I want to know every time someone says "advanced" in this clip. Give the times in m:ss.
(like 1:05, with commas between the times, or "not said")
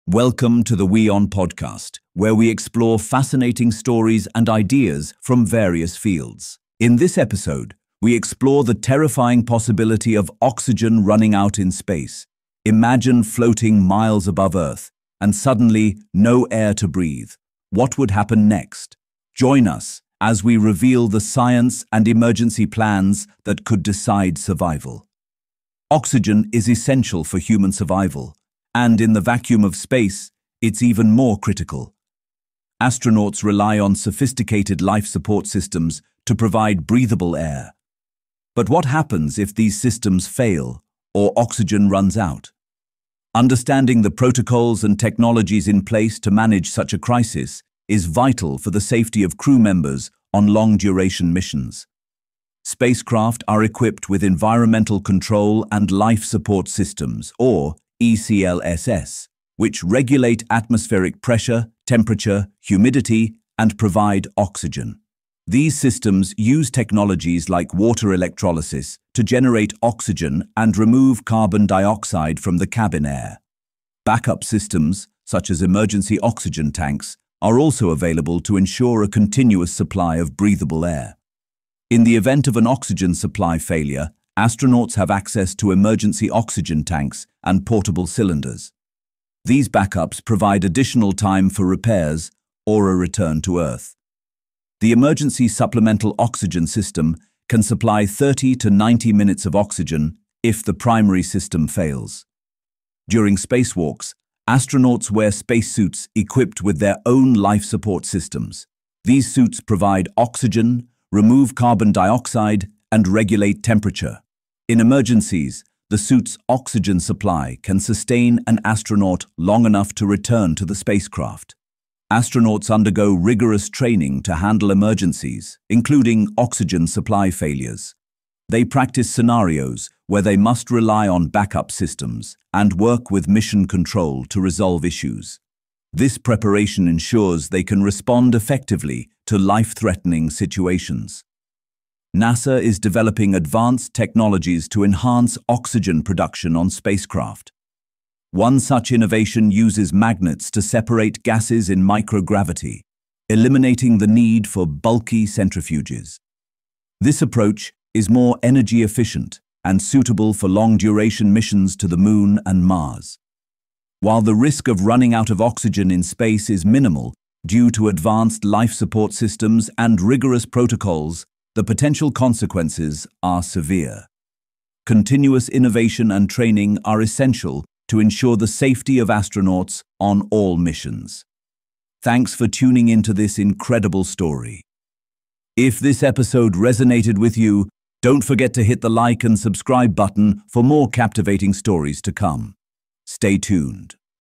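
2:23, 2:47.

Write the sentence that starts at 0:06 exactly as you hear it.
In this episode, we explore the terrifying possibility of oxygen running out in space.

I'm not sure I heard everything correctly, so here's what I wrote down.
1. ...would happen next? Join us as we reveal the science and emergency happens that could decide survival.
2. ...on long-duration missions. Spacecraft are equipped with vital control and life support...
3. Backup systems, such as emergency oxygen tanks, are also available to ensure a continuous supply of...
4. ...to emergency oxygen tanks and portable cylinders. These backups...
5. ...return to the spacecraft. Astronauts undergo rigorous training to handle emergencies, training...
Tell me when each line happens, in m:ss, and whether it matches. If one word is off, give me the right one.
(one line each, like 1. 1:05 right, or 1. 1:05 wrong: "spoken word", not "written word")
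1. 0:17 wrong: "plans", not "happens"
2. 0:50 wrong: "environmental", not "vital"
3. 1:14 right
4. 1:25 right
5. 2:00 wrong: "including", not "training".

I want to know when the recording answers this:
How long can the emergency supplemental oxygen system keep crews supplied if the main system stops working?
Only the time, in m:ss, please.
1:38.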